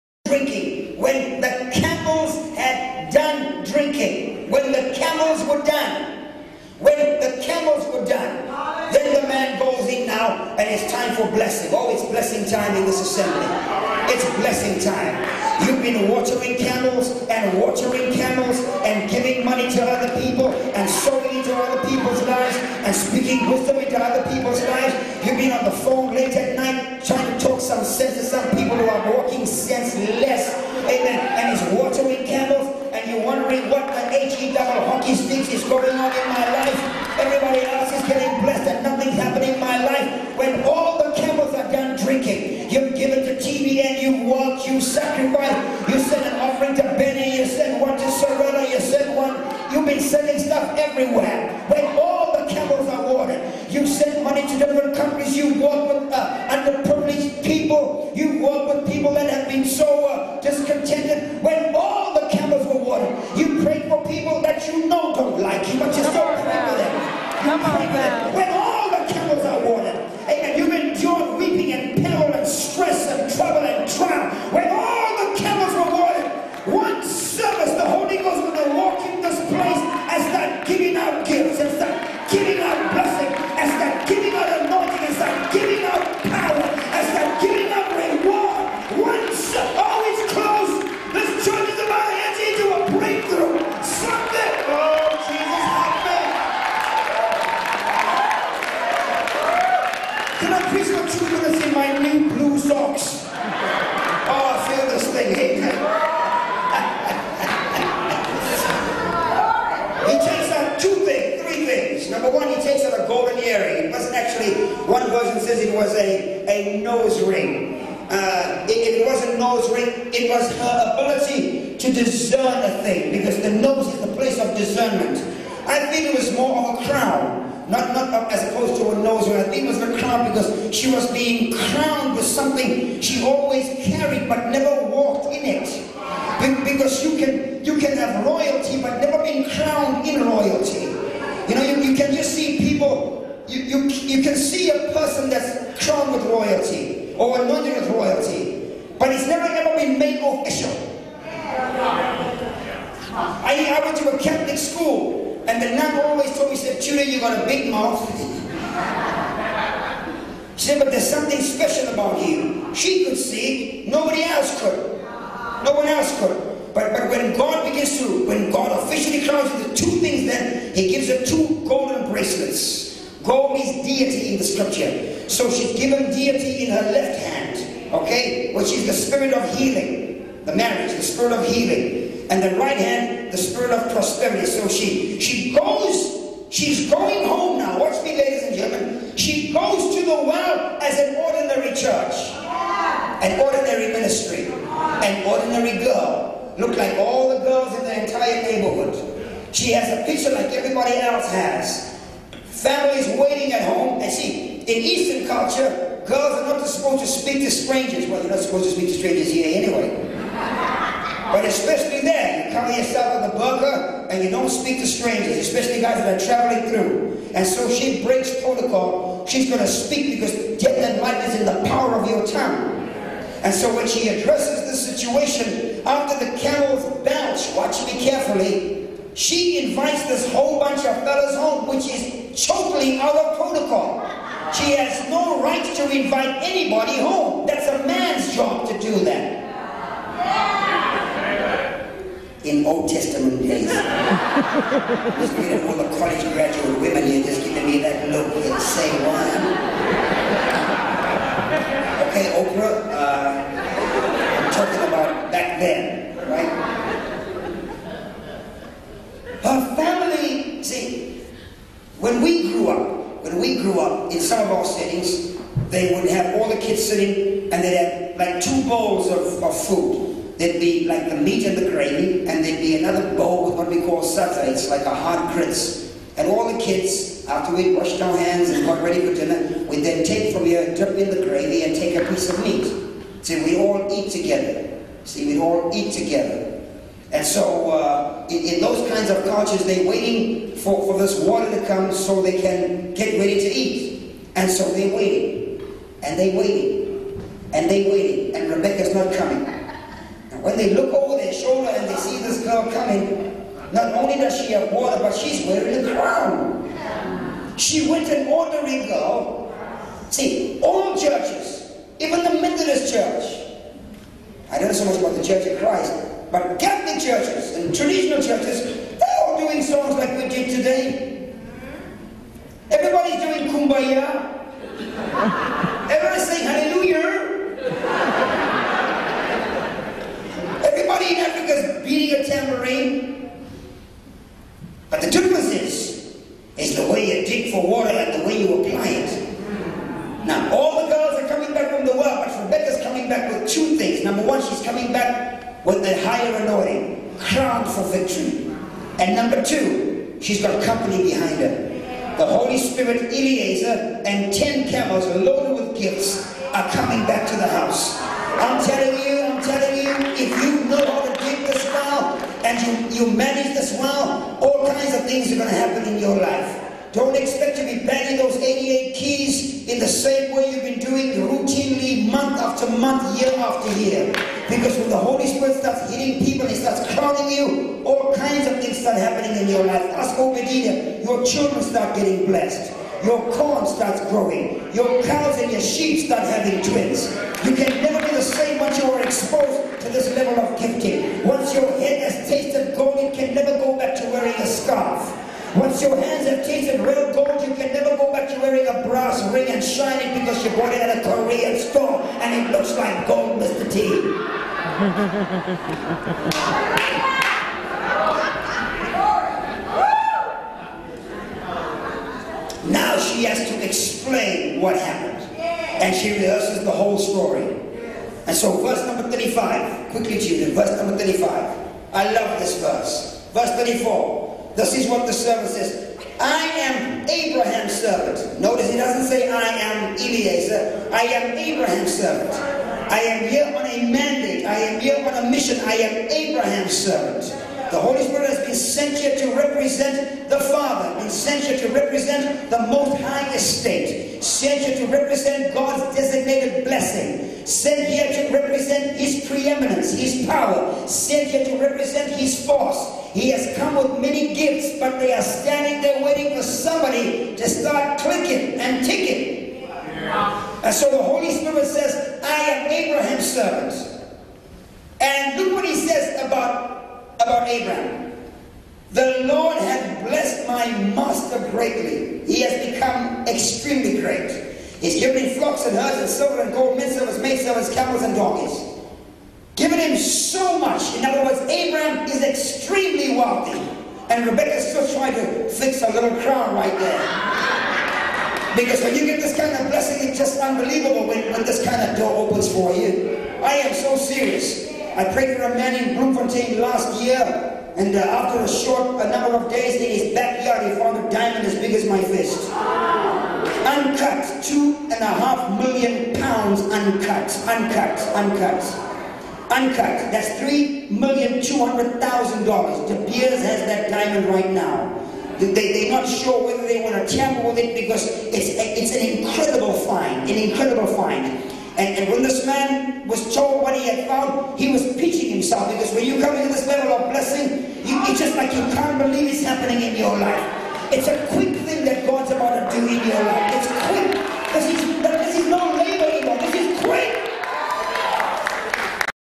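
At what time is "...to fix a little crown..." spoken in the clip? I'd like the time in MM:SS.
08:05.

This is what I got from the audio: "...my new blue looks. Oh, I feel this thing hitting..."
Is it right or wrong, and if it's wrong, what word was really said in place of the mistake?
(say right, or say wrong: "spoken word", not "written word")
wrong: "socks", not "looks".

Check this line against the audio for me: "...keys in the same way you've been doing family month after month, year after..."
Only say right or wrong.
wrong.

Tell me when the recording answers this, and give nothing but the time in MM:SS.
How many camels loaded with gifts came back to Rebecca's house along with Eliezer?
05:54.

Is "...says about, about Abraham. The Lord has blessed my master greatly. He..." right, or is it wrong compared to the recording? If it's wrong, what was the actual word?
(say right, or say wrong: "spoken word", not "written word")
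right.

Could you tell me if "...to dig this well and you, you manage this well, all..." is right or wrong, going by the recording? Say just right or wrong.
right.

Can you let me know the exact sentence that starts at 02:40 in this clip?
she said, but there's something special about you.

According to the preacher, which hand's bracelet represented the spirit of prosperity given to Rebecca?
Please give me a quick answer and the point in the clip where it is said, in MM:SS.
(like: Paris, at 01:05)
right hand, at 03:02.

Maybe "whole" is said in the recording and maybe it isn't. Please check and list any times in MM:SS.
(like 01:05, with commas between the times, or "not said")
03:50, 06:56.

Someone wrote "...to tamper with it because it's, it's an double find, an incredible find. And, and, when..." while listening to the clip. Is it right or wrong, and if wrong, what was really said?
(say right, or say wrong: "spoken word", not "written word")
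wrong: "incredible", not "double".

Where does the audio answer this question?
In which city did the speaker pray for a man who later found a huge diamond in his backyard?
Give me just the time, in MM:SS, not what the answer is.
08:15.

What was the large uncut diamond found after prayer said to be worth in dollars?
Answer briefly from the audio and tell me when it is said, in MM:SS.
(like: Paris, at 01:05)
$3,200,000, at 08:30.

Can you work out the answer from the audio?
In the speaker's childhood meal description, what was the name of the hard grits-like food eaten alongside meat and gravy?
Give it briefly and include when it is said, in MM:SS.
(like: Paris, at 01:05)
sadza, at 04:34.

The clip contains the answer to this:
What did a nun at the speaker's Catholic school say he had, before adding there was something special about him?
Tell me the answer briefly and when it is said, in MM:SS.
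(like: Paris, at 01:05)
a big mouth, at 02:37.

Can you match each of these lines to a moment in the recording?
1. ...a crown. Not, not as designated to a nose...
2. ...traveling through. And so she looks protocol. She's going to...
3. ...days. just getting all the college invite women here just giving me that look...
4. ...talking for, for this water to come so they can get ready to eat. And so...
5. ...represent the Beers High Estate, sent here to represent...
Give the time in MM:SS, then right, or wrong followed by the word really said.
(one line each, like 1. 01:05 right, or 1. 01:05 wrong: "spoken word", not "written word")
1. 02:06 wrong: "opposed", not "designated"
2. 03:36 wrong: "breaks", not "looks"
3. 04:03 wrong: "graduate", not "invite"
4. 04:49 wrong: "waiting", not "talking"
5. 07:21 wrong: "Most", not "Beers".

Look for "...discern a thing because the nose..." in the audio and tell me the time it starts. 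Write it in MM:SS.
02:01.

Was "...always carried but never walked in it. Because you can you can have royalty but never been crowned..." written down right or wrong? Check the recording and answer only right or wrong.
right.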